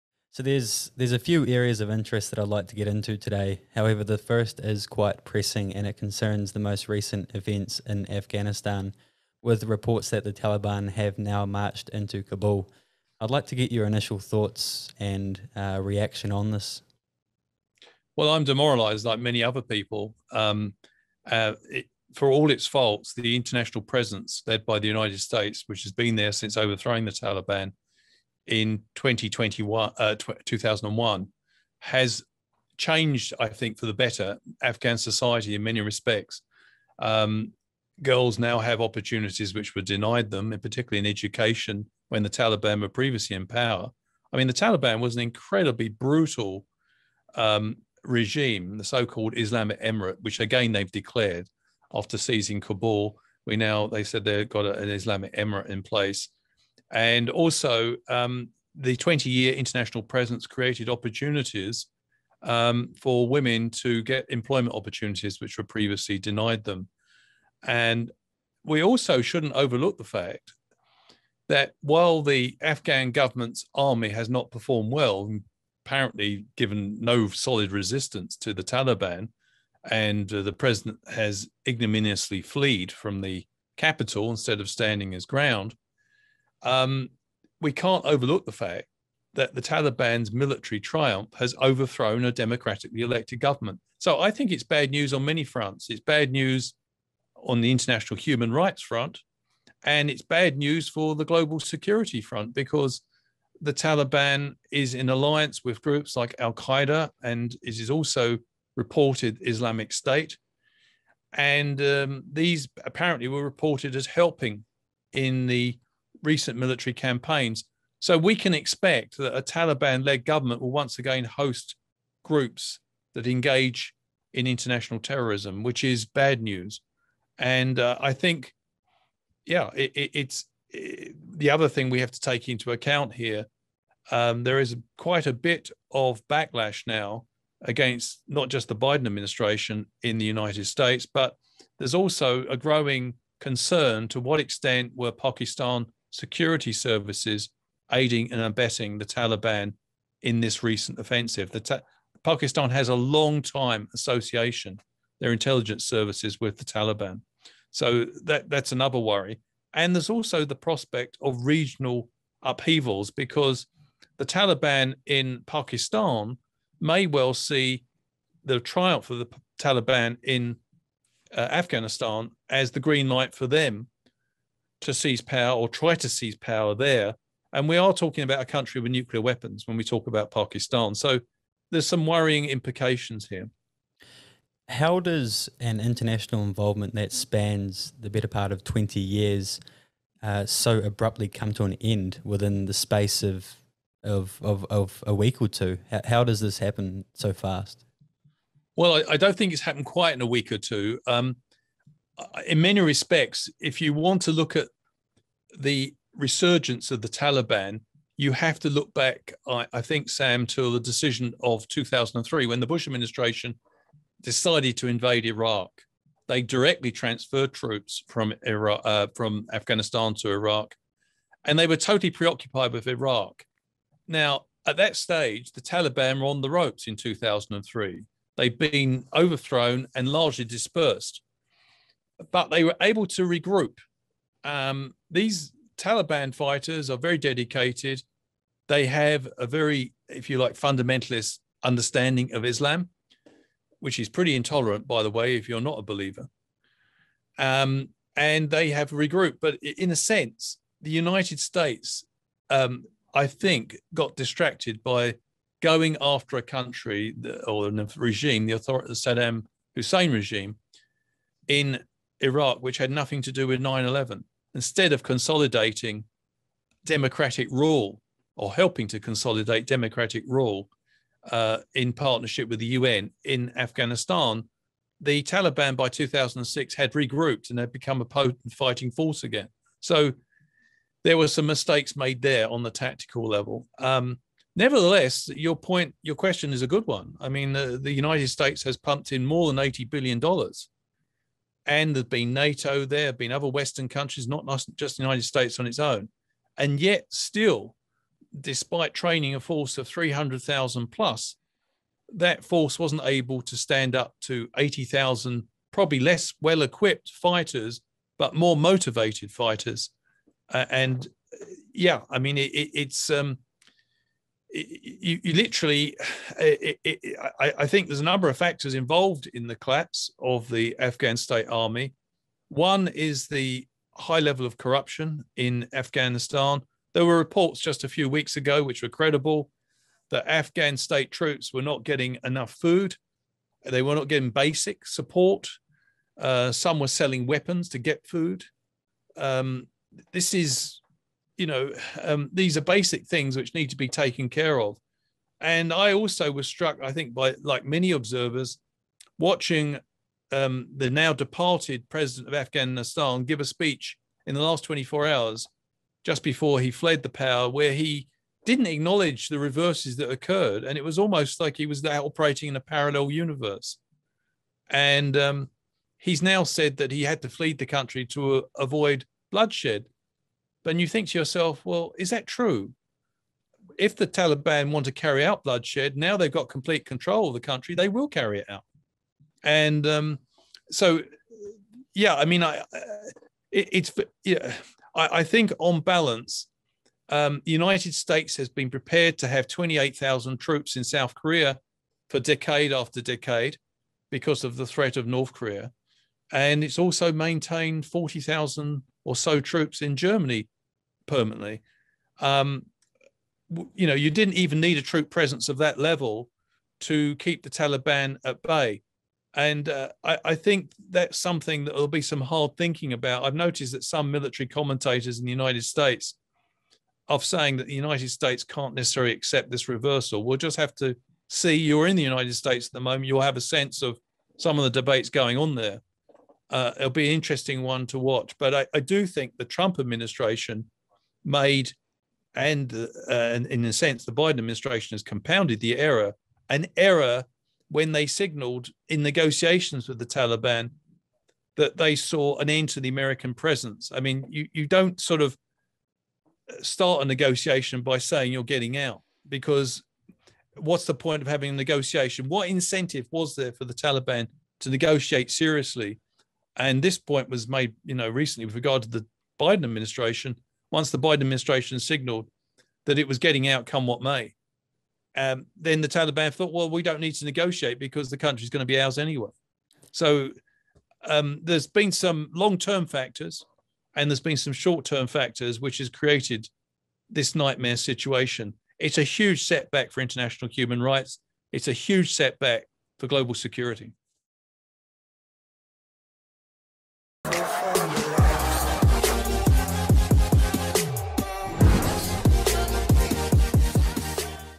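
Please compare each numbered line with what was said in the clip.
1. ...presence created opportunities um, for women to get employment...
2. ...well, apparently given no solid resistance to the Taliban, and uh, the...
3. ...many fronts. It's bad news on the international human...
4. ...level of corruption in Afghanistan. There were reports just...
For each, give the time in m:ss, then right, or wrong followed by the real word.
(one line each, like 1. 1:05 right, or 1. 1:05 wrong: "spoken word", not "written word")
1. 1:00 right
2. 1:14 right
3. 1:35 right
4. 5:24 right.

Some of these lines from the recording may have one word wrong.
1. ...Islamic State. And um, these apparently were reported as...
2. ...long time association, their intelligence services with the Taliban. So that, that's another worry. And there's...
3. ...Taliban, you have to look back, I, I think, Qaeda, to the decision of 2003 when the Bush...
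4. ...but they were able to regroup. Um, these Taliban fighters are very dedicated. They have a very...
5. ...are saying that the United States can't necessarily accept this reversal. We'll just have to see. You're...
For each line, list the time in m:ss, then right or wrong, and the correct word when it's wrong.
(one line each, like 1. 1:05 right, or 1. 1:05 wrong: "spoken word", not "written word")
1. 1:49 right
2. 2:32 right
3. 3:27 wrong: "Sam", not "Qaeda"
4. 3:52 right
5. 6:57 right.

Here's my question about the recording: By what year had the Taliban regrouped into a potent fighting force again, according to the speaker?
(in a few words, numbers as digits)
2006.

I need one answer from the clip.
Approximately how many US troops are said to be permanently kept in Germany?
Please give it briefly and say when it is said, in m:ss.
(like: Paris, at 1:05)
40,000, at 6:37.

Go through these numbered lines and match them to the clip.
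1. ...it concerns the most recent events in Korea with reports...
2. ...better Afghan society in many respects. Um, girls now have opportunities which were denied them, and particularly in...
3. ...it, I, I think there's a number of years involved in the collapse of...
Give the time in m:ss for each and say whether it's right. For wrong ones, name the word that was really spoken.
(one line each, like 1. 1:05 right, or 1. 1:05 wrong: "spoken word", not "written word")
1. 0:05 wrong: "Afghanistan", not "Korea"
2. 0:33 right
3. 5:16 wrong: "factors", not "years".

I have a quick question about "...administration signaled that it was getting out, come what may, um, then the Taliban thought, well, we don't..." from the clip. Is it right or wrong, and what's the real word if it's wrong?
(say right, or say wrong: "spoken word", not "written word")
right.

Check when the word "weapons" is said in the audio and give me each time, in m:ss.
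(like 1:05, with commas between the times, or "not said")
2:59, 5:37.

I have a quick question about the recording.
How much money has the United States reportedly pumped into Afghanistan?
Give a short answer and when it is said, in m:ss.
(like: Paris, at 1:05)
more than $80 billion, at 4:49.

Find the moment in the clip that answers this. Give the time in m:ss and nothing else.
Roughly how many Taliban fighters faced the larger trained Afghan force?
5:04.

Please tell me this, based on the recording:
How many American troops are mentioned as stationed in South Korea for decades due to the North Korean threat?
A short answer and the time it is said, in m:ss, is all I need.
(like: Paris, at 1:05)
28,000, at 6:29.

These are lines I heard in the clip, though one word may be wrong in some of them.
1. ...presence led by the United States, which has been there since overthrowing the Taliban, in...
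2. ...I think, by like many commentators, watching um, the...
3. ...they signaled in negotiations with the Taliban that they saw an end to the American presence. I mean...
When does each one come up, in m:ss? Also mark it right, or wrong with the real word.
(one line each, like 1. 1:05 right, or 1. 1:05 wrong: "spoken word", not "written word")
1. 0:23 right
2. 5:46 wrong: "observers", not "commentators"
3. 7:17 right.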